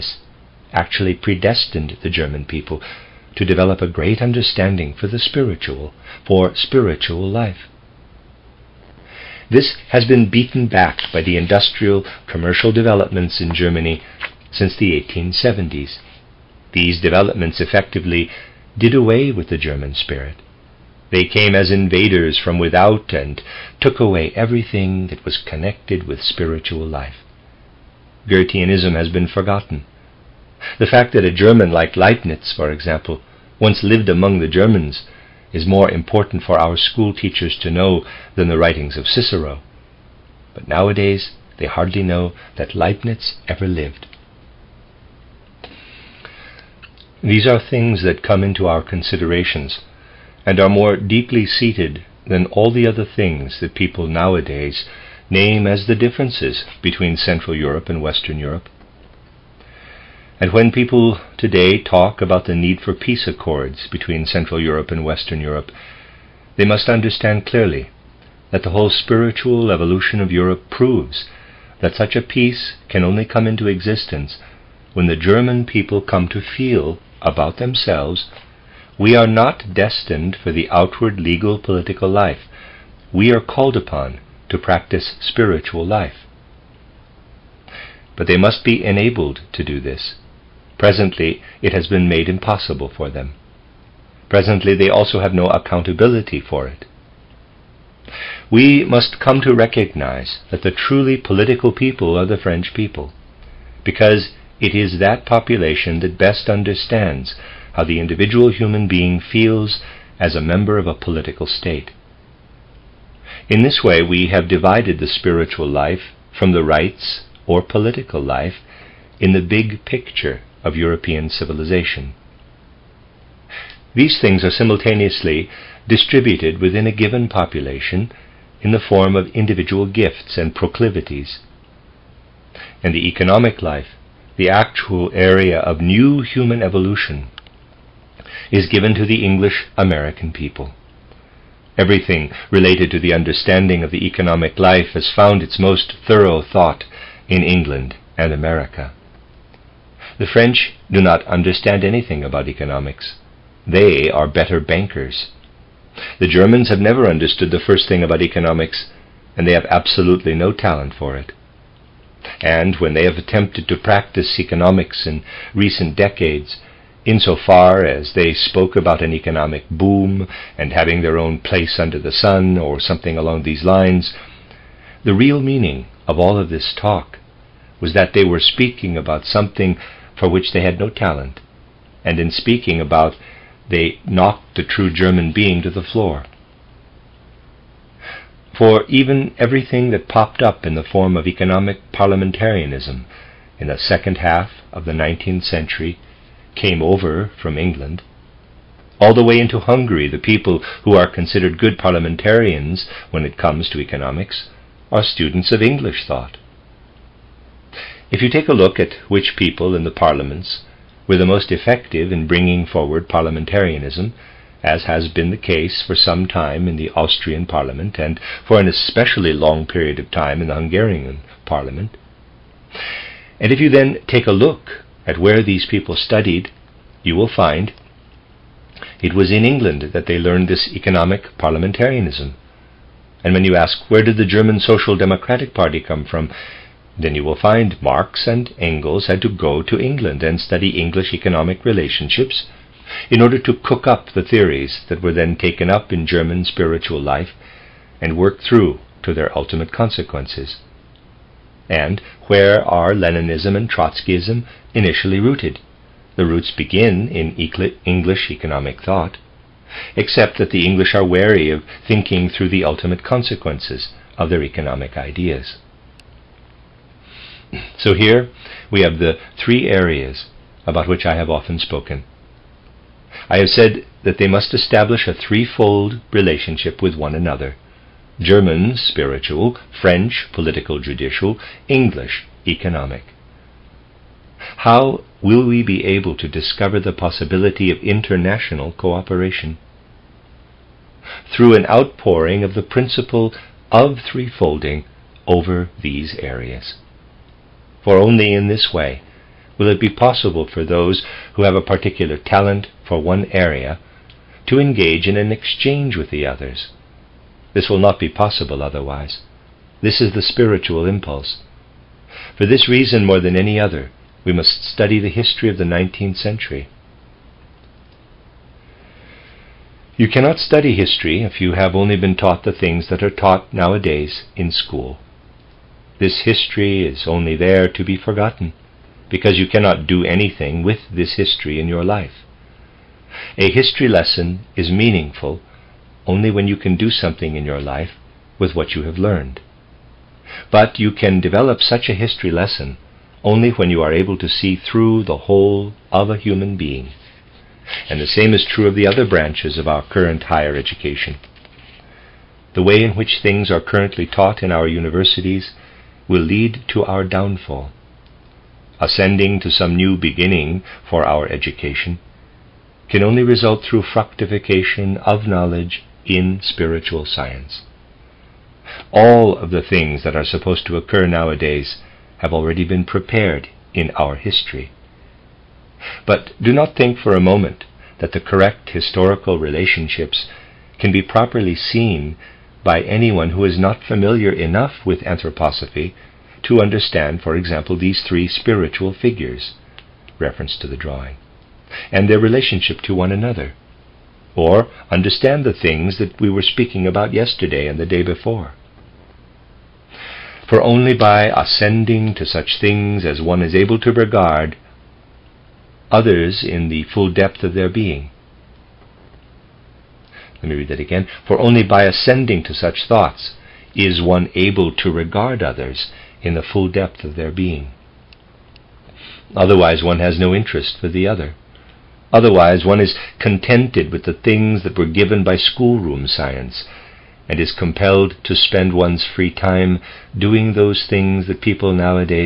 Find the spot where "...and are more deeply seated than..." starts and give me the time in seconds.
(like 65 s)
50 s.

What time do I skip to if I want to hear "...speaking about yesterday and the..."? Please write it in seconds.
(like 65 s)
396 s.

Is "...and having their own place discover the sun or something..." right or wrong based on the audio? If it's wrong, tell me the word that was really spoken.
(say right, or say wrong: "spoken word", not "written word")
wrong: "under", not "discover".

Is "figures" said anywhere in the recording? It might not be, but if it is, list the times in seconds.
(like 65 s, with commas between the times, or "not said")
388 s.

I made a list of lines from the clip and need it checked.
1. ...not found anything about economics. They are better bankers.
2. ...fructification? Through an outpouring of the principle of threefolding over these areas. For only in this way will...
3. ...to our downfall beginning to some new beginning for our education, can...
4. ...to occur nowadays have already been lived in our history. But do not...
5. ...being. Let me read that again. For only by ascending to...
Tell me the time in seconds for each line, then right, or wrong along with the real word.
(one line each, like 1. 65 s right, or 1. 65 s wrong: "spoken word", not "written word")
1. 150 s wrong: "understand", not "found"
2. 288 s wrong: "cooperation", not "fructification"
3. 356 s wrong: "ascending", not "beginning"
4. 370 s wrong: "prepared", not "lived"
5. 407 s right.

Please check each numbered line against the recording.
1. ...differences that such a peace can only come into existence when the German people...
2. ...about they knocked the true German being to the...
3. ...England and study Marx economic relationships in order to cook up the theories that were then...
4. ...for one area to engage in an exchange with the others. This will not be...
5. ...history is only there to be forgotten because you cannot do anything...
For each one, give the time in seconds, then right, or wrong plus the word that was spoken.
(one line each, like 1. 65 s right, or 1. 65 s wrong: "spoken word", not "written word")
1. 70 s wrong: "proves", not "differences"
2. 182 s right
3. 239 s wrong: "English", not "Marx"
4. 302 s right
5. 326 s right.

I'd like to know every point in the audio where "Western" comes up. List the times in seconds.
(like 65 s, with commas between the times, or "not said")
58 s, 65 s.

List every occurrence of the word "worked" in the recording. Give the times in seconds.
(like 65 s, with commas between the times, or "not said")
248 s.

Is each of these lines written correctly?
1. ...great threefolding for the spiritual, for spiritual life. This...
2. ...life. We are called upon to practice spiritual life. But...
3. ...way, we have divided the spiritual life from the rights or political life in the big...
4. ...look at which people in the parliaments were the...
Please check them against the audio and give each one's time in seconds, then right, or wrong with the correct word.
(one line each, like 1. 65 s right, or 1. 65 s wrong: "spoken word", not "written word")
1. 3 s wrong: "understanding", not "threefolding"
2. 82 s right
3. 113 s right
4. 208 s right.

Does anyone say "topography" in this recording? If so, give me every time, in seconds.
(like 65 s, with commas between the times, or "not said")
not said.